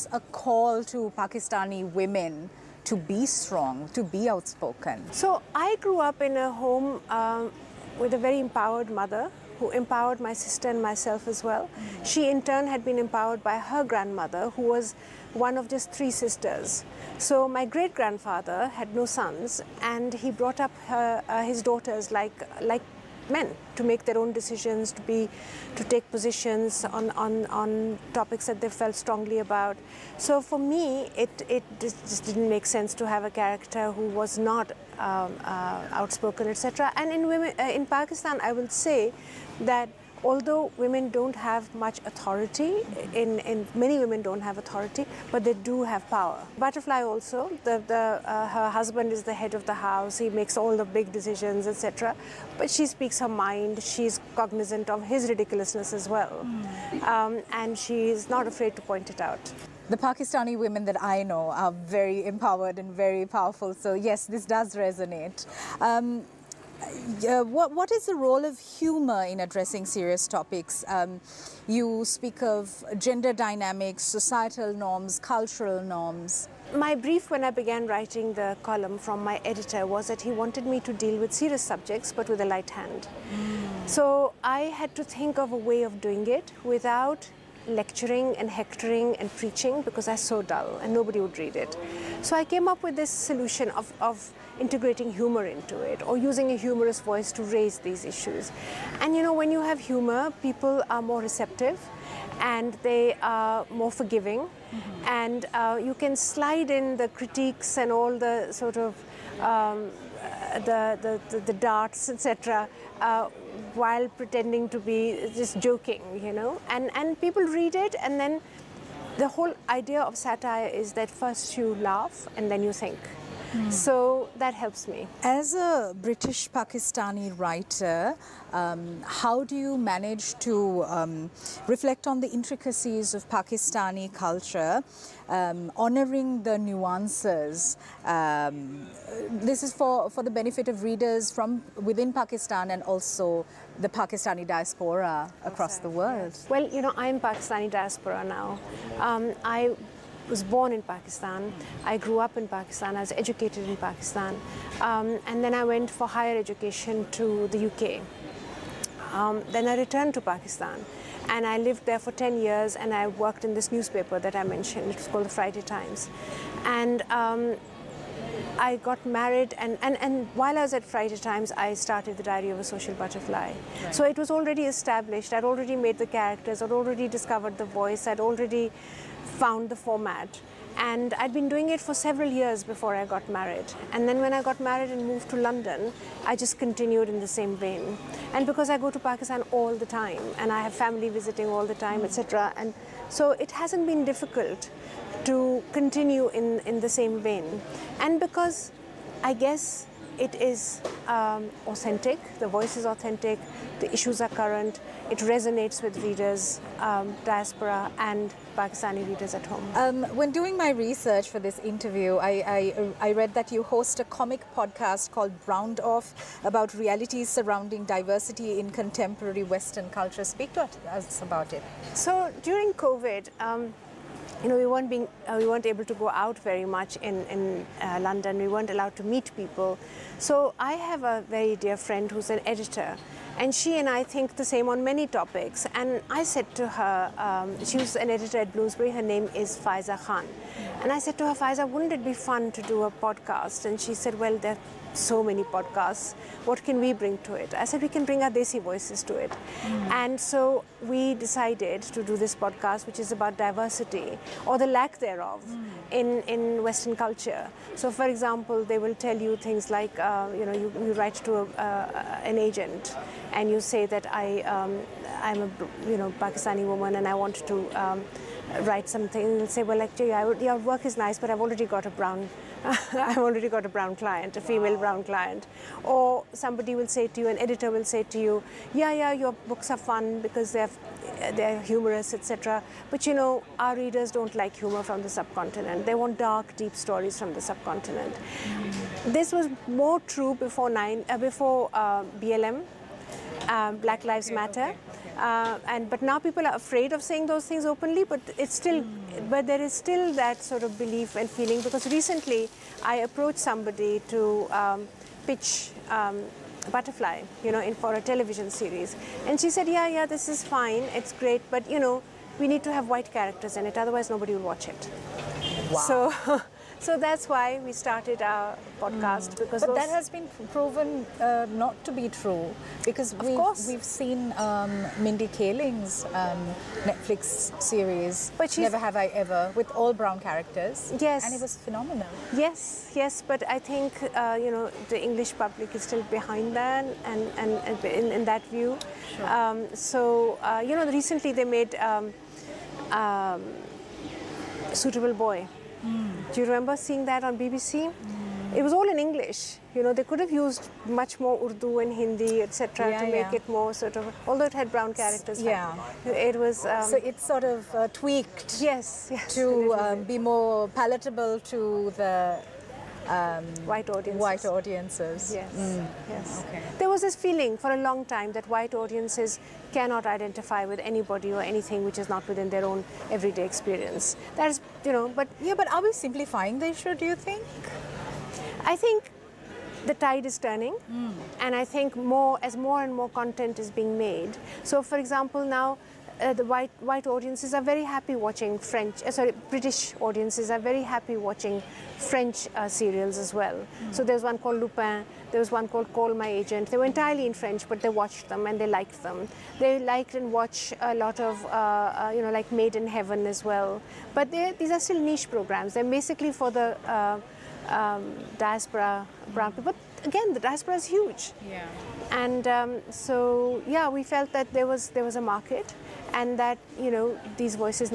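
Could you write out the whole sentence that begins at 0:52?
But she speaks her mind, she's cognizant of his ridiculousness as well, mm.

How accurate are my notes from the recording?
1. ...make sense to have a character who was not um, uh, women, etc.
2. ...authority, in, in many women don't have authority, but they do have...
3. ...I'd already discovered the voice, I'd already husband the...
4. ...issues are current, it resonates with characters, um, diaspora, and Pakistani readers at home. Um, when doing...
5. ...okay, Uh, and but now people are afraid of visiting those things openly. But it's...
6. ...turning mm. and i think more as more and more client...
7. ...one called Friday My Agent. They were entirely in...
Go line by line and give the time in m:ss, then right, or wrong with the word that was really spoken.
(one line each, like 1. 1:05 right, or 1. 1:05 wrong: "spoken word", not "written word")
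1. 0:32 wrong: "outspoken", not "women"
2. 0:42 right
3. 2:56 wrong: "found", not "husband"
4. 3:23 wrong: "readers", not "characters"
5. 4:54 wrong: "saying", not "visiting"
6. 6:20 wrong: "content", not "client"
7. 6:35 wrong: "Call", not "Friday".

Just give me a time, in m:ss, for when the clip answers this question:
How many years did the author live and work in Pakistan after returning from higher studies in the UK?
2:42.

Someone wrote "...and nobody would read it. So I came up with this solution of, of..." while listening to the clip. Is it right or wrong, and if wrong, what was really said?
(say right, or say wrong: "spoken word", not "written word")
right.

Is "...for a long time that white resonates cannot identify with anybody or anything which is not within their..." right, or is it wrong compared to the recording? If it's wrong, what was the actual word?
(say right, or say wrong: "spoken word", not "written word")
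wrong: "audiences", not "resonates".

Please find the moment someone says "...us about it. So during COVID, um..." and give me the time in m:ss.
3:40.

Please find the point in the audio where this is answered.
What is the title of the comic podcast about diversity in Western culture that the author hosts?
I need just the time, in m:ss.
3:35.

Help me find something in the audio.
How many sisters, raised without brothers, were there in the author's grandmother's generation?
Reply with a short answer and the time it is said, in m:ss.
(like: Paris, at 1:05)
3, at 0:15.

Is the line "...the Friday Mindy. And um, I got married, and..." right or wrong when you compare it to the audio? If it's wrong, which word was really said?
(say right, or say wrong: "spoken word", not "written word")
wrong: "Times", not "Mindy".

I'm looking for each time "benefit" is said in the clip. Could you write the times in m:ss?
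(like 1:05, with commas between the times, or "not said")
2:20.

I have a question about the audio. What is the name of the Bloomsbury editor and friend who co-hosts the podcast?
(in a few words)
Faiza Khan.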